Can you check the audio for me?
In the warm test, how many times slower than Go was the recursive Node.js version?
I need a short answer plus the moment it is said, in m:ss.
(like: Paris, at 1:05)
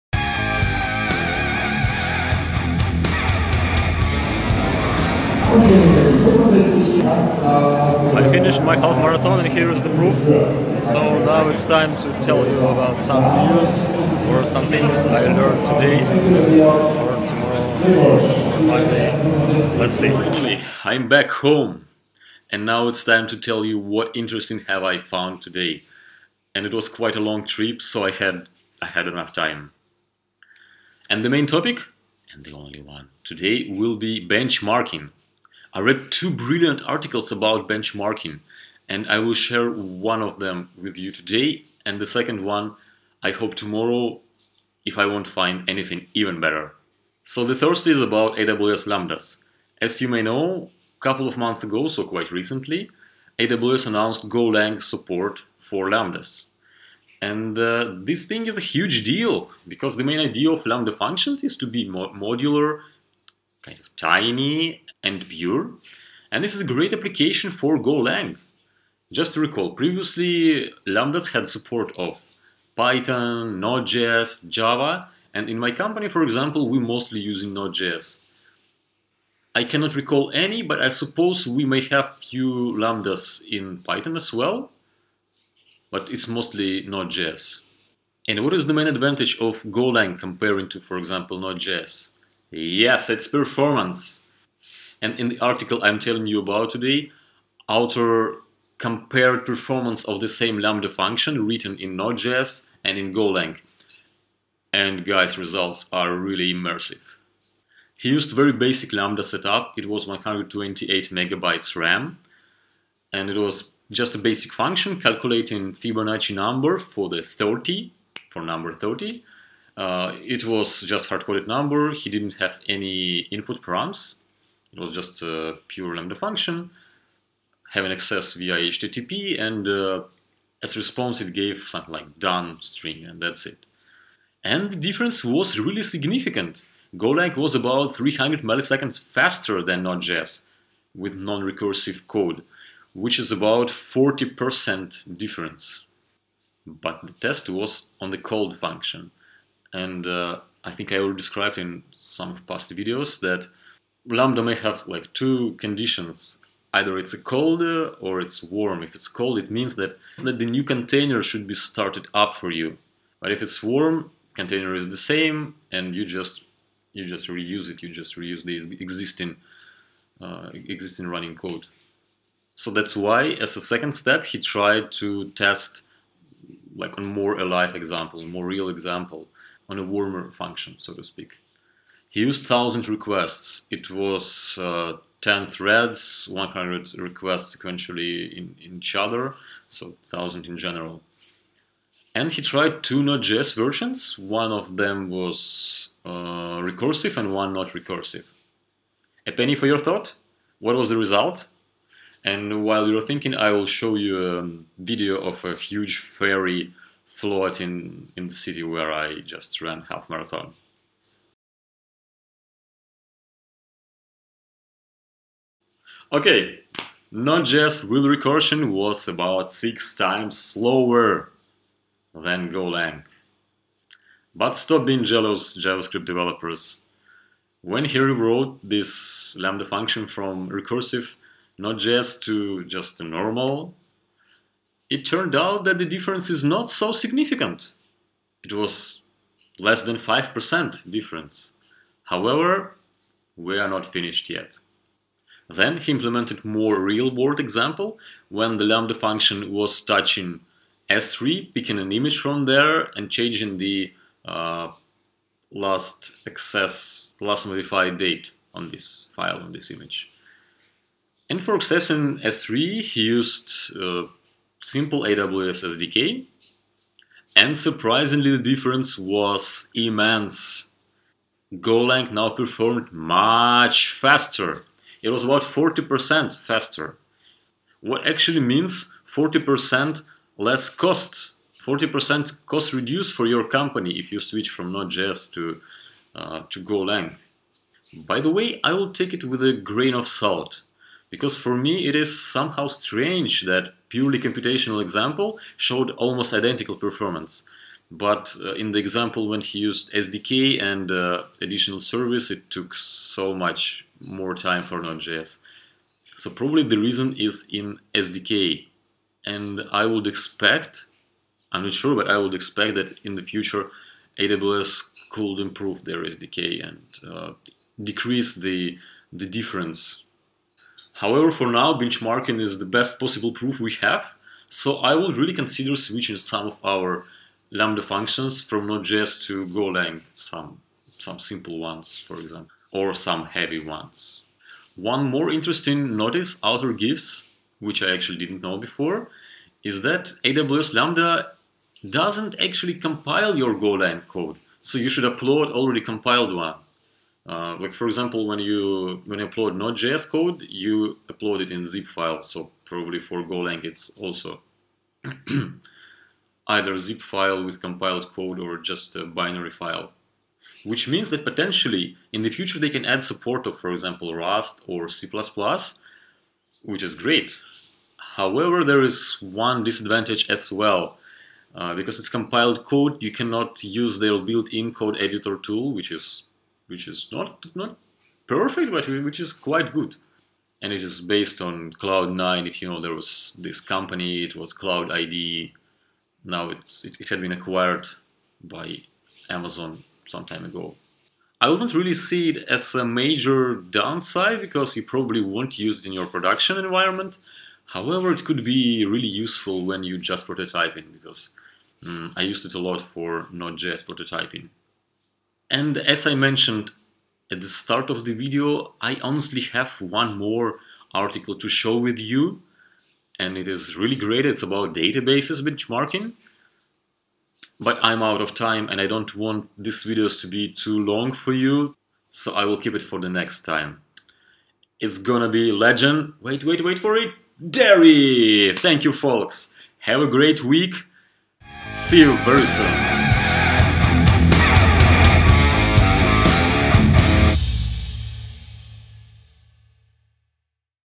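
6, at 3:39.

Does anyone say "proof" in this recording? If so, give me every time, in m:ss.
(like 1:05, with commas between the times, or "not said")
0:09, 5:23.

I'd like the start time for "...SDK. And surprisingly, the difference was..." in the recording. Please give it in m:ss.
4:25.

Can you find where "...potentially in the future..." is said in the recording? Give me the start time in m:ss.
6:01.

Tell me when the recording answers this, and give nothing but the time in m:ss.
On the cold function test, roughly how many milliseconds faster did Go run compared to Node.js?
2:17.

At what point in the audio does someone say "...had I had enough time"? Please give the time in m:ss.
0:28.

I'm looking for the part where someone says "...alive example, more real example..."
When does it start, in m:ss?
2:57.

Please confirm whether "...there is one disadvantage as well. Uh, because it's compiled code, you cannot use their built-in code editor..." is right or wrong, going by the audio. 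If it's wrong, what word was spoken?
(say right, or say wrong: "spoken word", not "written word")
right.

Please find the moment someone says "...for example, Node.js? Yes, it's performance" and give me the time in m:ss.
1:30.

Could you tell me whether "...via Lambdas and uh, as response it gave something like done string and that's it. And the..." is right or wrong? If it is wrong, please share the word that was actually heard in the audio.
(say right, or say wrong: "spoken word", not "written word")
wrong: "HTTP", not "Lambdas".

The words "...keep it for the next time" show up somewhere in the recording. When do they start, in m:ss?
7:02.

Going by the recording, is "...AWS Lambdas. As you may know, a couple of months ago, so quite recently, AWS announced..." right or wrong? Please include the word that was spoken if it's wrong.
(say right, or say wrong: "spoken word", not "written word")
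right.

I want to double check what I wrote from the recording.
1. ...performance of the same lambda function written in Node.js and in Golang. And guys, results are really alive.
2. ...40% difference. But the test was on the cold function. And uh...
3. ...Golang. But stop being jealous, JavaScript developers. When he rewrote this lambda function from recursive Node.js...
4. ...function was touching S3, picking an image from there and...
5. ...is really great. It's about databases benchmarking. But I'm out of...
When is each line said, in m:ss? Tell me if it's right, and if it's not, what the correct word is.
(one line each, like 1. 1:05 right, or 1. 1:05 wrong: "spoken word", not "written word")
1. 1:39 wrong: "immersive", not "alive"
2. 2:23 right
3. 3:42 right
4. 4:08 right
5. 6:53 right.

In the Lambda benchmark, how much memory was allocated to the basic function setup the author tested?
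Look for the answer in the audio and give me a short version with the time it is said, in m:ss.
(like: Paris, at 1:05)
128 megabytes, at 1:50.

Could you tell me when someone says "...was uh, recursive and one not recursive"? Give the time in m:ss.
3:15.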